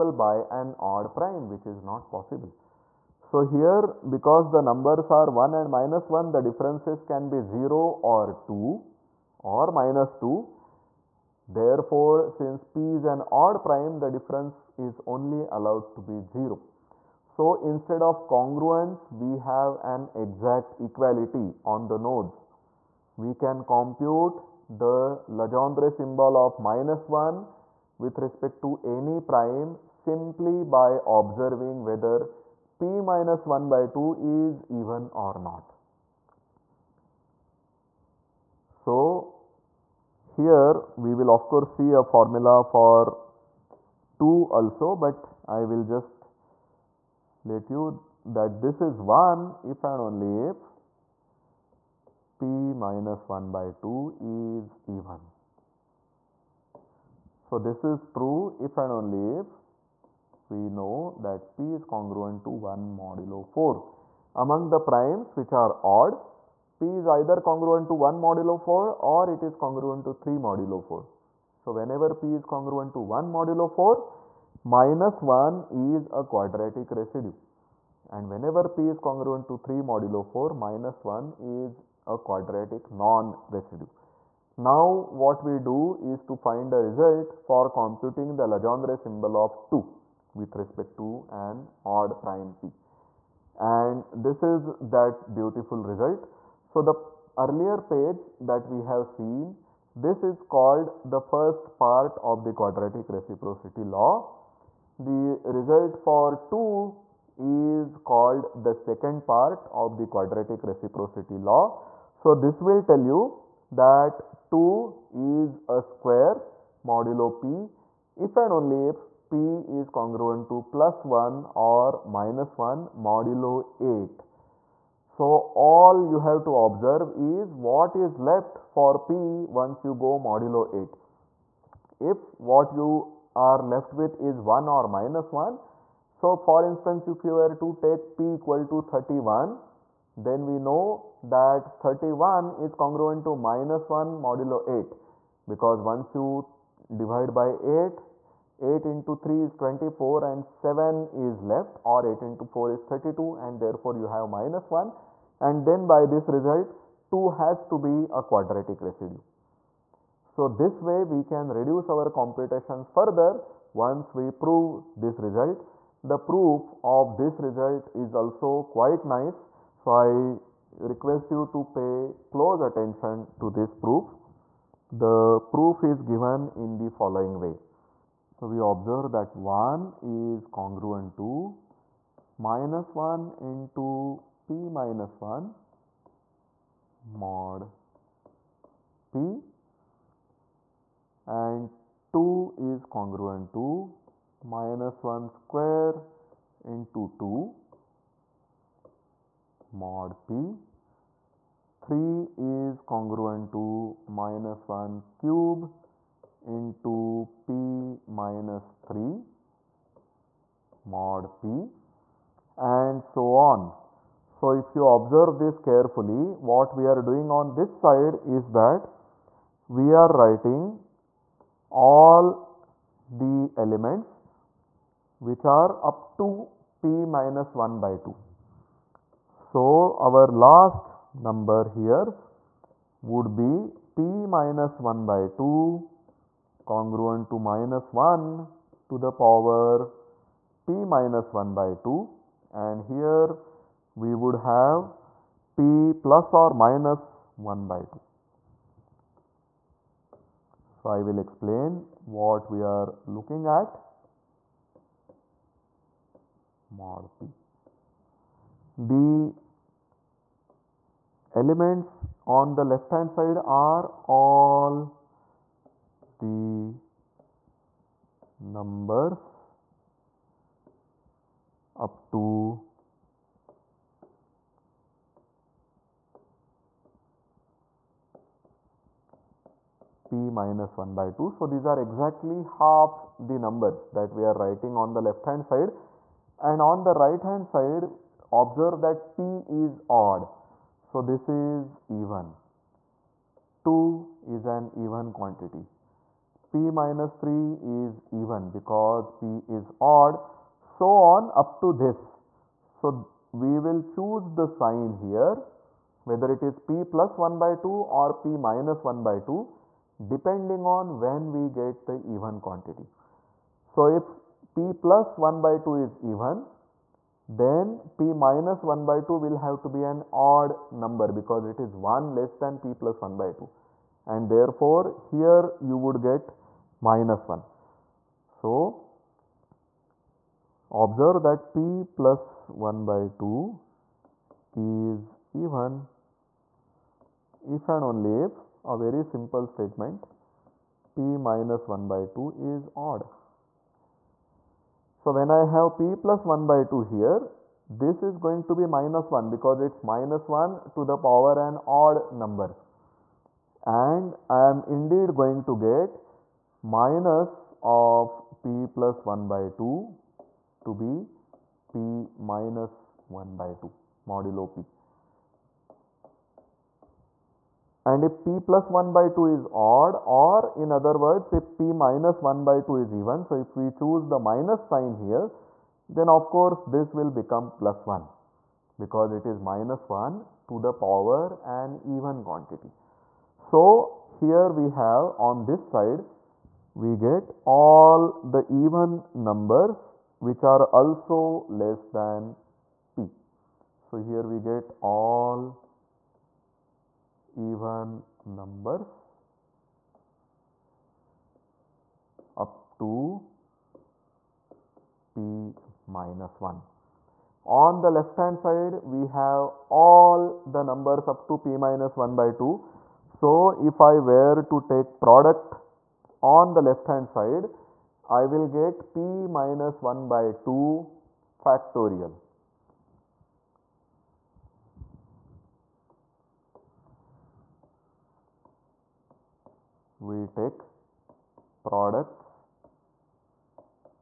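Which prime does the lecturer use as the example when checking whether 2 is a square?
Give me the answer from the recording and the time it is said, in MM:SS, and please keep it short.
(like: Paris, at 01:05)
31, at 02:18.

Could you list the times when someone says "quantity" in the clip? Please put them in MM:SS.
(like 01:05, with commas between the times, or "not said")
04:55, 05:12, 06:22.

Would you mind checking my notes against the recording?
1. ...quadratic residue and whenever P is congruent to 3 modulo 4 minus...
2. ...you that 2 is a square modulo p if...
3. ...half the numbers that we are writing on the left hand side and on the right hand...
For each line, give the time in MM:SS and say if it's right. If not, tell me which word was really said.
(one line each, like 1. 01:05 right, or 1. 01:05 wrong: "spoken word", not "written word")
1. 01:16 right
2. 01:53 right
3. 04:42 right.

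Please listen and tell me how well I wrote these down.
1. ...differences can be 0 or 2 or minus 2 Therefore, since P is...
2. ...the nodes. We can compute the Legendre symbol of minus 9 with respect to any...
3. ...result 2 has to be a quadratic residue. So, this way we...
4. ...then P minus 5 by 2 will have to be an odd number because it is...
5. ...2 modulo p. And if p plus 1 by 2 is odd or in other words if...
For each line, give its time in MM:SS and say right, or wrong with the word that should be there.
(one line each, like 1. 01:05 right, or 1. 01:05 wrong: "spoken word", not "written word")
1. 00:06 right
2. 00:21 wrong: "1", not "9"
3. 02:36 right
4. 05:17 wrong: "1", not "5"
5. 06:03 right.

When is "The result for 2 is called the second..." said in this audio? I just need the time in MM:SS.
01:44.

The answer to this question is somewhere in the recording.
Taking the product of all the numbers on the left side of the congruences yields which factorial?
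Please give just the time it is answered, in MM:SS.
06:58.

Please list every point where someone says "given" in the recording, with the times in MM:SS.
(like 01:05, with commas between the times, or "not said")
02:56.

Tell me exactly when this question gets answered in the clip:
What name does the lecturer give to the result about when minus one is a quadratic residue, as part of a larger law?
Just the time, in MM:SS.
01:41.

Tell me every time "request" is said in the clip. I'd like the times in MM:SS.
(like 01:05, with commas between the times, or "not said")
02:50.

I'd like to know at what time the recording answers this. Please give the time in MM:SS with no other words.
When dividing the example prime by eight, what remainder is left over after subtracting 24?
02:30.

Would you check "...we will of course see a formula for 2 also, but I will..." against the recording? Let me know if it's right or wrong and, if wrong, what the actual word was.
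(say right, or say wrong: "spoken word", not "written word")
right.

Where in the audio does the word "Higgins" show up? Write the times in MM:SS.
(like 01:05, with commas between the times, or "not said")
not said.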